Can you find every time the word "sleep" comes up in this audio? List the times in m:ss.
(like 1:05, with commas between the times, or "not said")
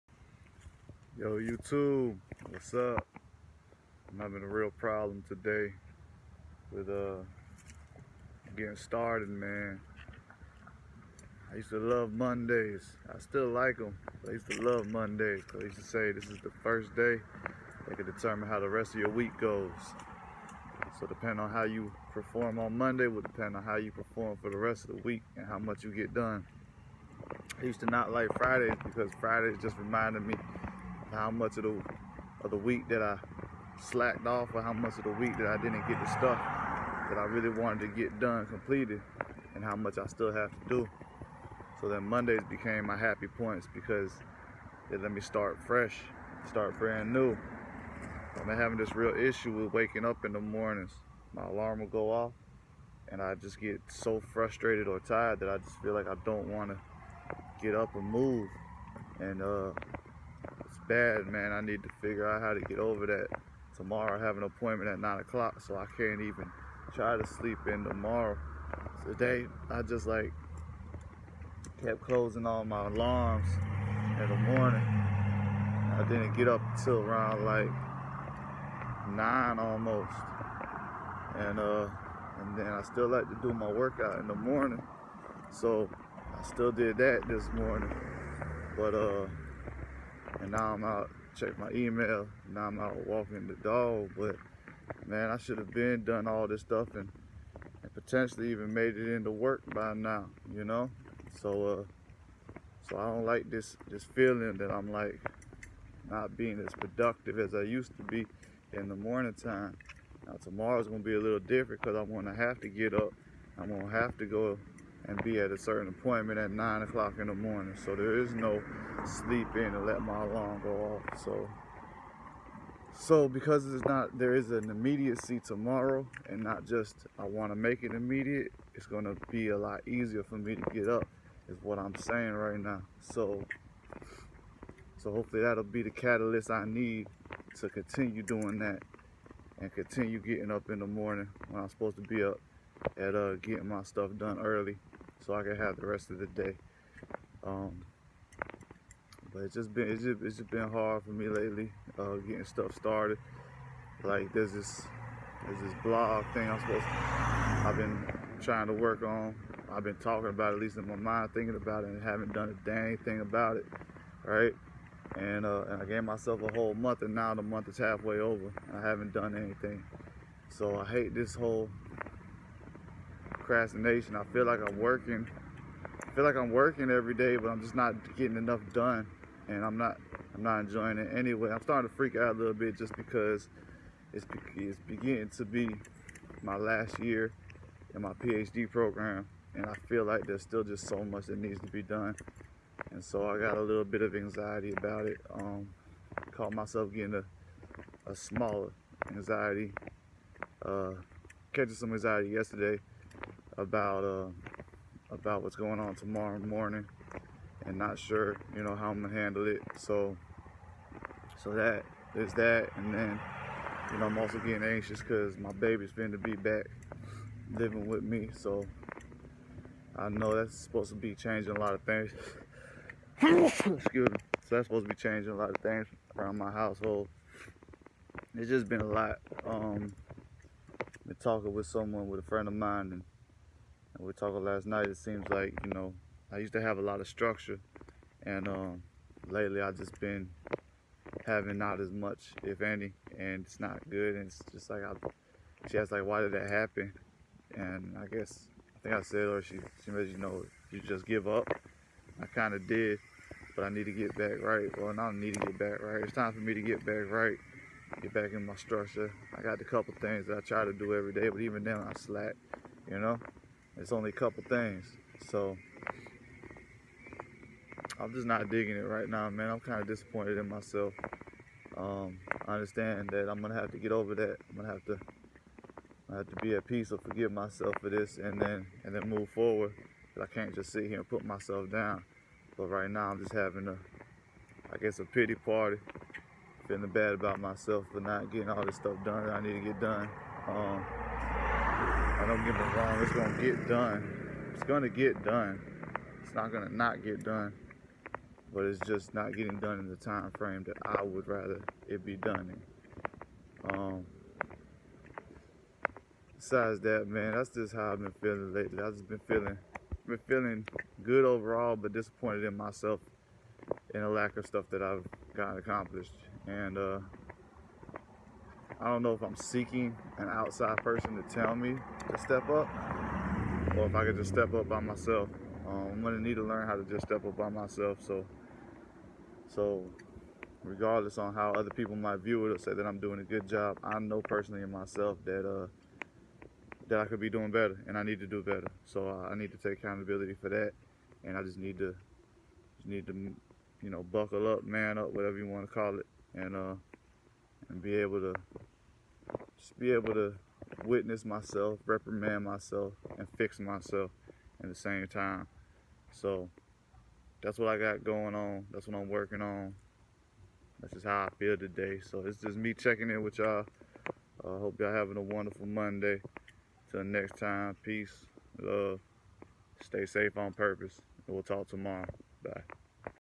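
1:07, 1:59.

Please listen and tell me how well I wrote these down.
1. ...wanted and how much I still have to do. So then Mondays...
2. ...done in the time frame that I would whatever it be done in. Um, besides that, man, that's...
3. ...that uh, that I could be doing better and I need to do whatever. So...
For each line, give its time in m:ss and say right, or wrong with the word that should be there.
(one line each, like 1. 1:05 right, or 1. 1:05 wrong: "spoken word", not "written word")
1. 0:38 wrong: "completed", not "wanted"
2. 4:59 wrong: "rather", not "whatever"
3. 5:35 wrong: "better", not "whatever".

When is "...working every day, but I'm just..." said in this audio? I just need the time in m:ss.
2:56.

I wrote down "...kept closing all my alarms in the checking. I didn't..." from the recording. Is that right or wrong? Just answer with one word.
wrong.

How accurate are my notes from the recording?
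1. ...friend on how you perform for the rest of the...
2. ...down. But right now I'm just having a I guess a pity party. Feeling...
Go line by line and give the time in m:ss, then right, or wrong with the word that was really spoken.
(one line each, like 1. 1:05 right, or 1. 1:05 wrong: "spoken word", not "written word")
1. 0:23 wrong: "depend", not "friend"
2. 4:41 right.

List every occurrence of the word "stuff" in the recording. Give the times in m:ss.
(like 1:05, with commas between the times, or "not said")
0:36, 1:36, 2:23, 2:32, 4:48, 5:14.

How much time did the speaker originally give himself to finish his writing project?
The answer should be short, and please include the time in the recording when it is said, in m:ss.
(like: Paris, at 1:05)
A whole month, at 2:46.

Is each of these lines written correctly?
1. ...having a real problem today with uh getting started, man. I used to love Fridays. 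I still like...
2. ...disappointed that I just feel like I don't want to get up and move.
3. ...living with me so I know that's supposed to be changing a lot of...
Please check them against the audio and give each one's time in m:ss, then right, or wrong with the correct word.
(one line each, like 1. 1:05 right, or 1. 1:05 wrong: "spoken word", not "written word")
1. 0:04 wrong: "Mondays", not "Fridays"
2. 0:54 wrong: "tired", not "disappointed"
3. 3:37 right.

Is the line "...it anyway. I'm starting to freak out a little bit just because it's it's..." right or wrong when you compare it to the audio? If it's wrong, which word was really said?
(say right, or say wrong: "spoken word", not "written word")
right.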